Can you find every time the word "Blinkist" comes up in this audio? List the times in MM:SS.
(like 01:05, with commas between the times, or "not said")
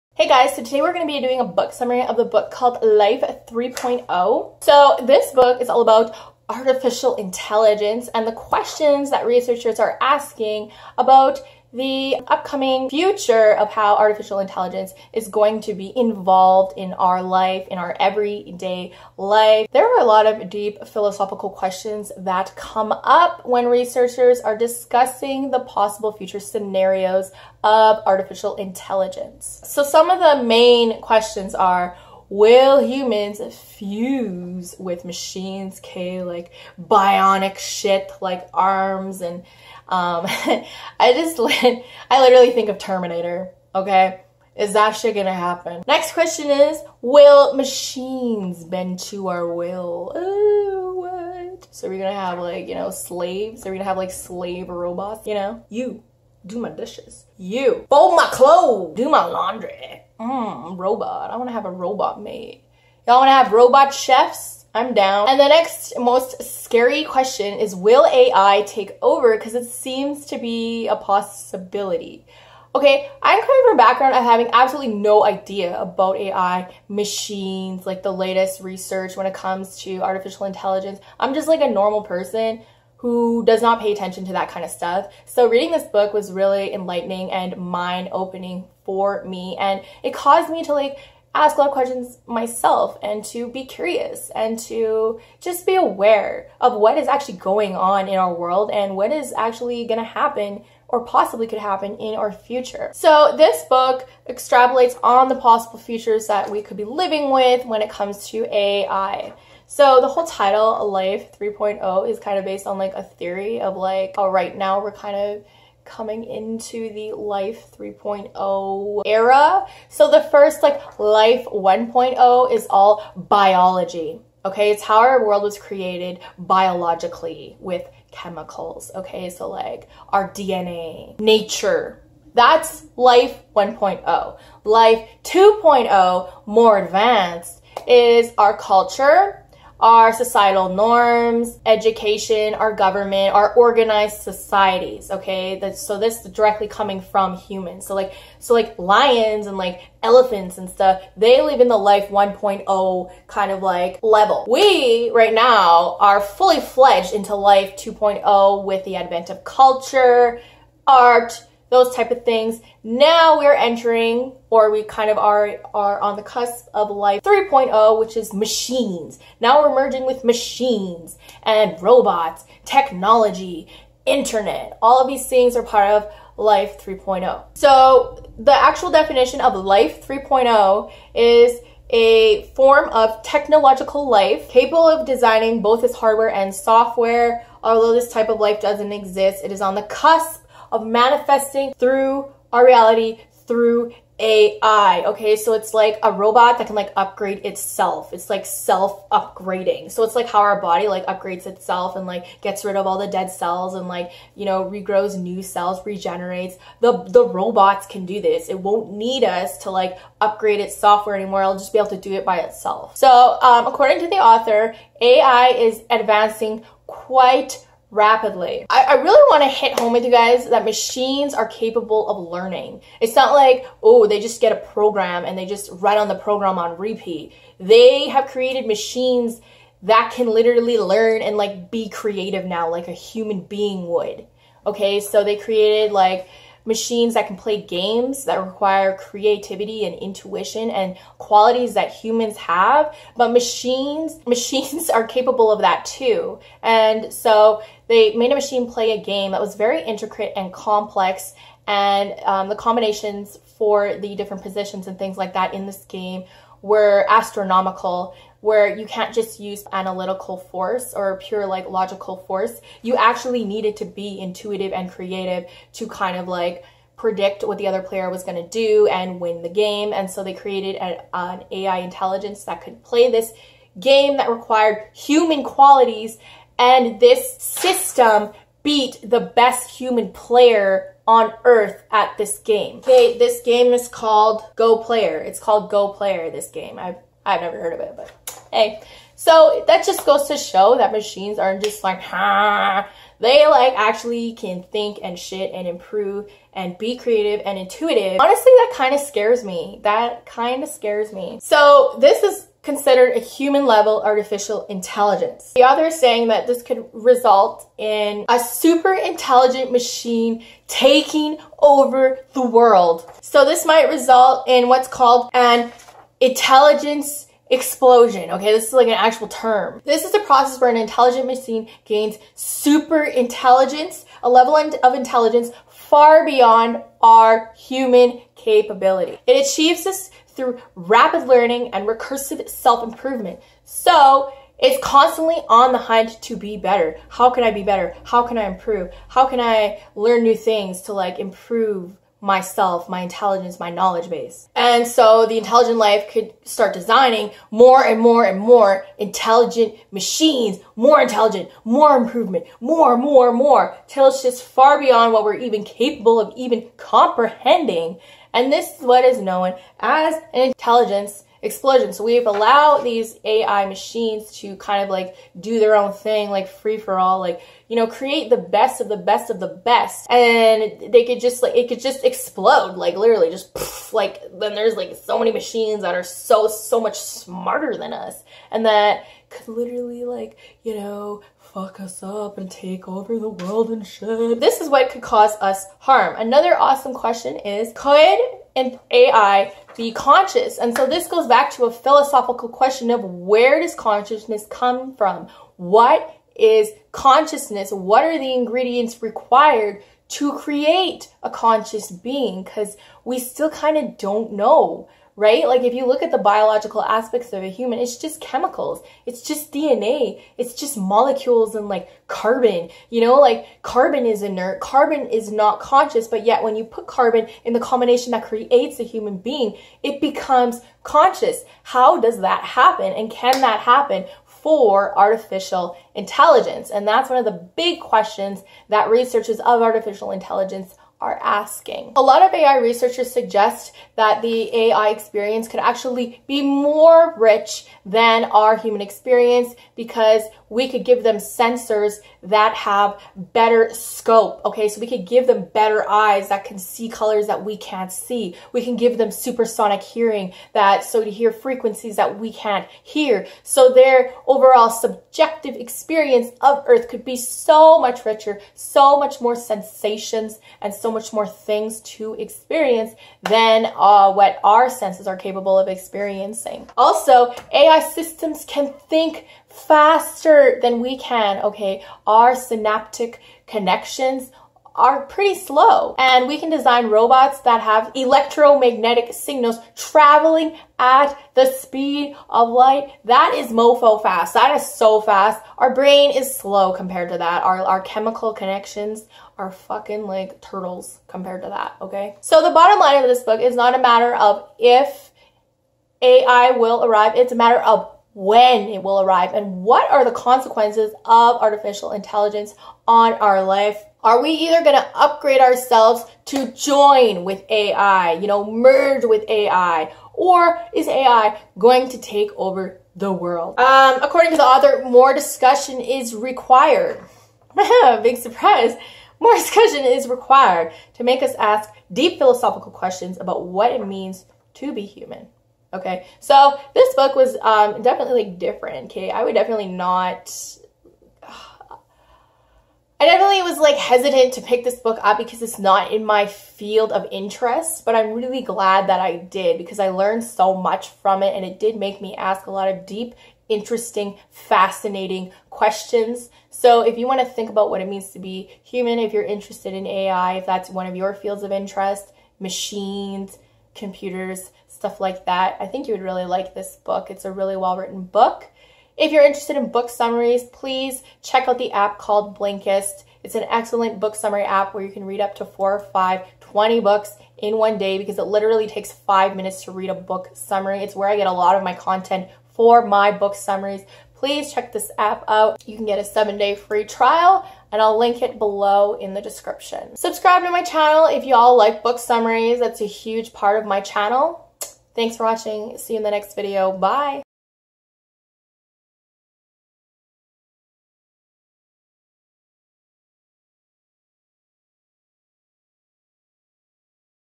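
09:22.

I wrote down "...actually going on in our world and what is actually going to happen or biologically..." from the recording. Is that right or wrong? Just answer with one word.
wrong.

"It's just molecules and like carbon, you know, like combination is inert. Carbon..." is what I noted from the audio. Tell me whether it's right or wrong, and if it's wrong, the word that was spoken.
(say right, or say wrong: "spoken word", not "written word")
wrong: "carbon", not "combination".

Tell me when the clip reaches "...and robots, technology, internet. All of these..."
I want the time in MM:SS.
02:51.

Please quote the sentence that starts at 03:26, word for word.
The the robots can do this.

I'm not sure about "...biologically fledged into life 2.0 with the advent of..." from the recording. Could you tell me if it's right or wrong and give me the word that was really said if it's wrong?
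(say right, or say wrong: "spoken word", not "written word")
wrong: "fully", not "biologically".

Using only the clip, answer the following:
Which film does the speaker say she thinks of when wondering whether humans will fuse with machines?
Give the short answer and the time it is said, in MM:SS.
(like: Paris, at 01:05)
Terminator, at 00:42.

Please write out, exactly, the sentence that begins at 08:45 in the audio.
Okay, so this book was um, definitely like different.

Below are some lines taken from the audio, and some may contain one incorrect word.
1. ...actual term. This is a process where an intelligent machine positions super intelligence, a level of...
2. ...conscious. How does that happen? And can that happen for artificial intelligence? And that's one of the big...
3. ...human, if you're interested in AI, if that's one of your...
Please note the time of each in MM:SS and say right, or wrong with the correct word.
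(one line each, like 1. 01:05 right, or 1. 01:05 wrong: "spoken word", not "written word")
1. 05:18 wrong: "gains", not "positions"
2. 07:00 right
3. 09:08 right.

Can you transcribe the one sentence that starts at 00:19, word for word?
There are a lot of deep philosophical questions that come up when researchers are discussing the possible future scenarios of artificial intelligence.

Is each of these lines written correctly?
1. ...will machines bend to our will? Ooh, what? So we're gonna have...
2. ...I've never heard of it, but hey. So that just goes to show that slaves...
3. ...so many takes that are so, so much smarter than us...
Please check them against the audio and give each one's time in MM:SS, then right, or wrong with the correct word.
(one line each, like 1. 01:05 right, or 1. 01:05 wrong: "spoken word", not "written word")
1. 00:47 right
2. 04:47 wrong: "machines", not "slaves"
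3. 06:15 wrong: "machines", not "takes".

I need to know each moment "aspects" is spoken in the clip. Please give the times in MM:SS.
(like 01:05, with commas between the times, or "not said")
06:46.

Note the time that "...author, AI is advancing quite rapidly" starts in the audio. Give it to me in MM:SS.
03:34.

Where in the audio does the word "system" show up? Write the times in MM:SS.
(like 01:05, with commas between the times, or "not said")
04:37, 07:47.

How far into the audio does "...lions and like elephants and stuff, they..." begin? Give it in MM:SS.
02:28.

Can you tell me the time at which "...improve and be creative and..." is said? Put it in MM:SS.
04:55.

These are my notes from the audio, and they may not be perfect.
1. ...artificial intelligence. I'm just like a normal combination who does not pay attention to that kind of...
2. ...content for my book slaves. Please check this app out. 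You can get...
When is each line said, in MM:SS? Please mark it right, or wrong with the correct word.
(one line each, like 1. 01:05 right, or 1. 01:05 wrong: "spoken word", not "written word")
1. 01:19 wrong: "person", not "combination"
2. 09:31 wrong: "summaries", not "slaves".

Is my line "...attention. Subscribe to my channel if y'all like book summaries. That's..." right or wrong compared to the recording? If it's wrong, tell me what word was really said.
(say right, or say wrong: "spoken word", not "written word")
wrong: "description", not "attention".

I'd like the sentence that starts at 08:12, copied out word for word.
So the bottom line of this book is not a matter of if AI will arrive.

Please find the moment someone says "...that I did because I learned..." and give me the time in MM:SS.
08:58.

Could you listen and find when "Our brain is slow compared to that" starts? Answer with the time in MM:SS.
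08:05.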